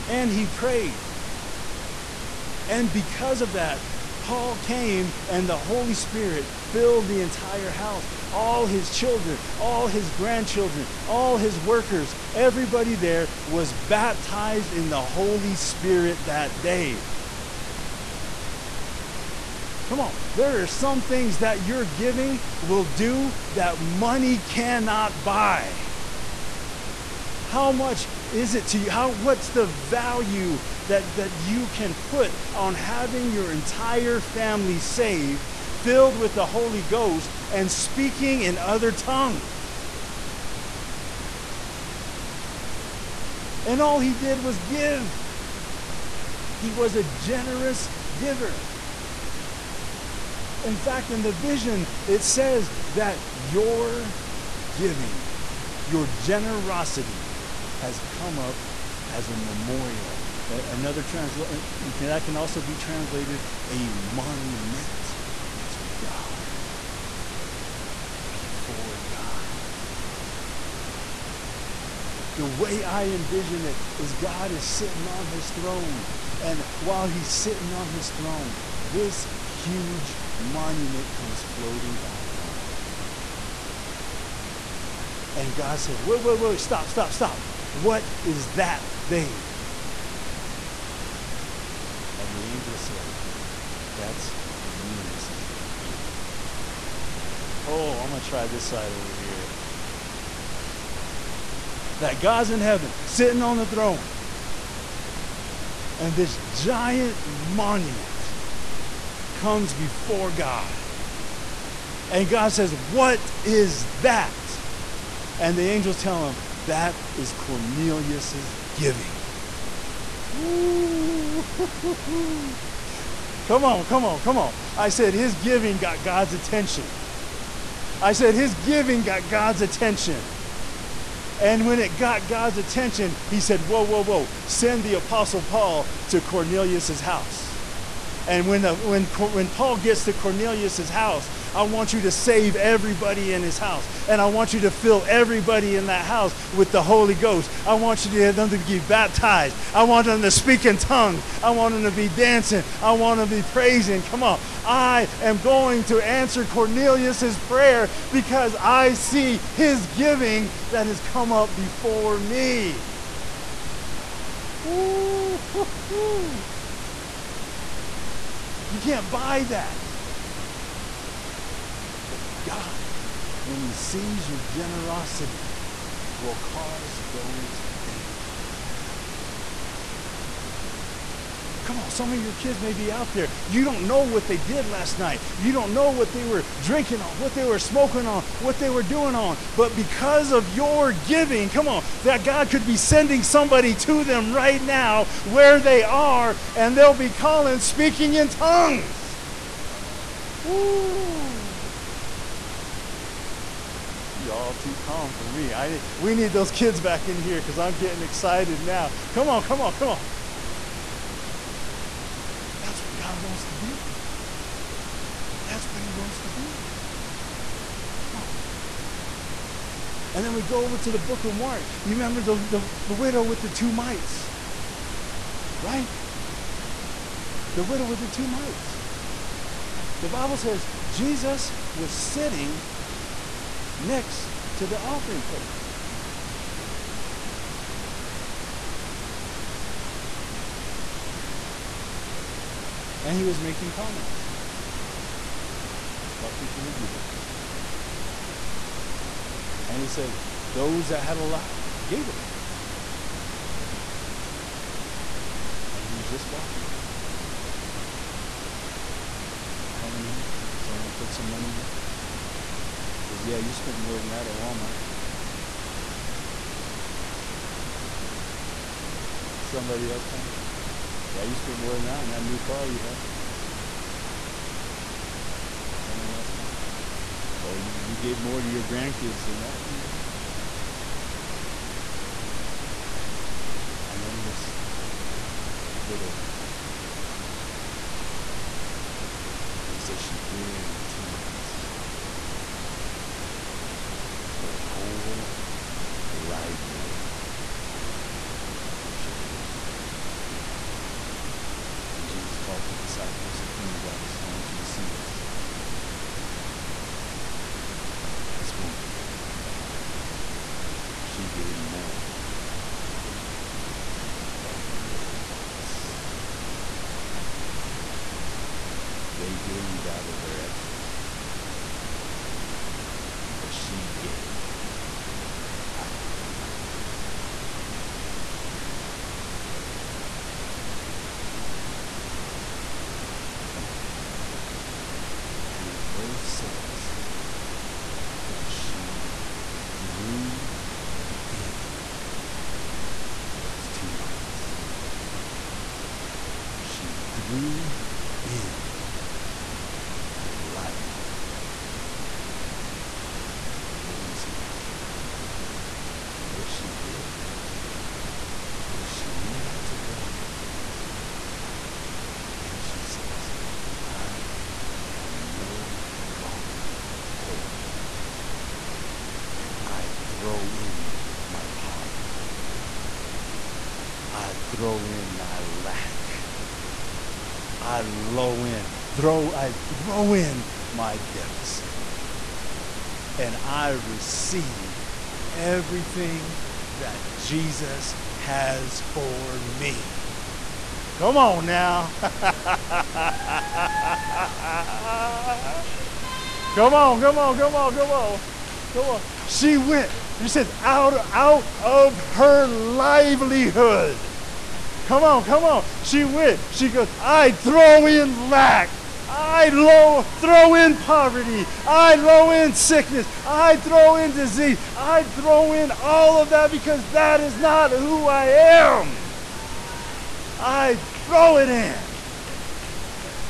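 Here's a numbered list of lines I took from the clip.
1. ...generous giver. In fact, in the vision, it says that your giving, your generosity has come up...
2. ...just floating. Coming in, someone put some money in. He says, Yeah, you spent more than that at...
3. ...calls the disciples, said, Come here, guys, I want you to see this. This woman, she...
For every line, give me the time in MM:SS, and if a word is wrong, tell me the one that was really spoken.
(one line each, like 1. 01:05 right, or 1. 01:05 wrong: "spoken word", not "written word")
1. 00:47 right
2. 04:16 wrong: "watching", not "floating"
3. 05:02 right.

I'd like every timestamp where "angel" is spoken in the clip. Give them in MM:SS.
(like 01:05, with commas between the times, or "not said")
01:32, 01:55.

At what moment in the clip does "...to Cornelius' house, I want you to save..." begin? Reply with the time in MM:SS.
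02:20.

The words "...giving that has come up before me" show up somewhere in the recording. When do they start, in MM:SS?
02:39.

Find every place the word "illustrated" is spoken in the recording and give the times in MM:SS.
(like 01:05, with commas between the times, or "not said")
not said.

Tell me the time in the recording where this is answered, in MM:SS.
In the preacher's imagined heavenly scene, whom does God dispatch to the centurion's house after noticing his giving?
02:14.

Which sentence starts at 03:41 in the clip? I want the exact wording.
You remember the, the, the widow with the two mites, right?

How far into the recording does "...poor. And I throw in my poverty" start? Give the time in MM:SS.
06:07.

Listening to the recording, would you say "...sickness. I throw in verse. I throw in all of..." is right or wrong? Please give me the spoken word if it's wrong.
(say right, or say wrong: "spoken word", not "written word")
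wrong: "disease", not "verse".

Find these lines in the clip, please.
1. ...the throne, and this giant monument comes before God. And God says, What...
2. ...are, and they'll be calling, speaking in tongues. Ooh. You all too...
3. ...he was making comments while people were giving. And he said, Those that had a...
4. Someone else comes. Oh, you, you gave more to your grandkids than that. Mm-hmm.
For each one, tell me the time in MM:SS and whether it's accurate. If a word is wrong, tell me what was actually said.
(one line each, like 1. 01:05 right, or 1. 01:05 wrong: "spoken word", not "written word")
1. 01:43 right
2. 03:15 right
3. 04:03 right
4. 04:35 right.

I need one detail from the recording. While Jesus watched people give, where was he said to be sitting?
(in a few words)
Next to the offering plate.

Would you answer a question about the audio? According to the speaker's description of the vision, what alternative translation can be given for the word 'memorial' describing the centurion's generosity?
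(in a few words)
A monument.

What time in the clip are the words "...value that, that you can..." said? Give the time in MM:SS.
00:29.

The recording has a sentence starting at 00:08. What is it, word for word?
All his children, all his grandchildren, all his workers, everybody there was baptized in the Holy Spirit that day.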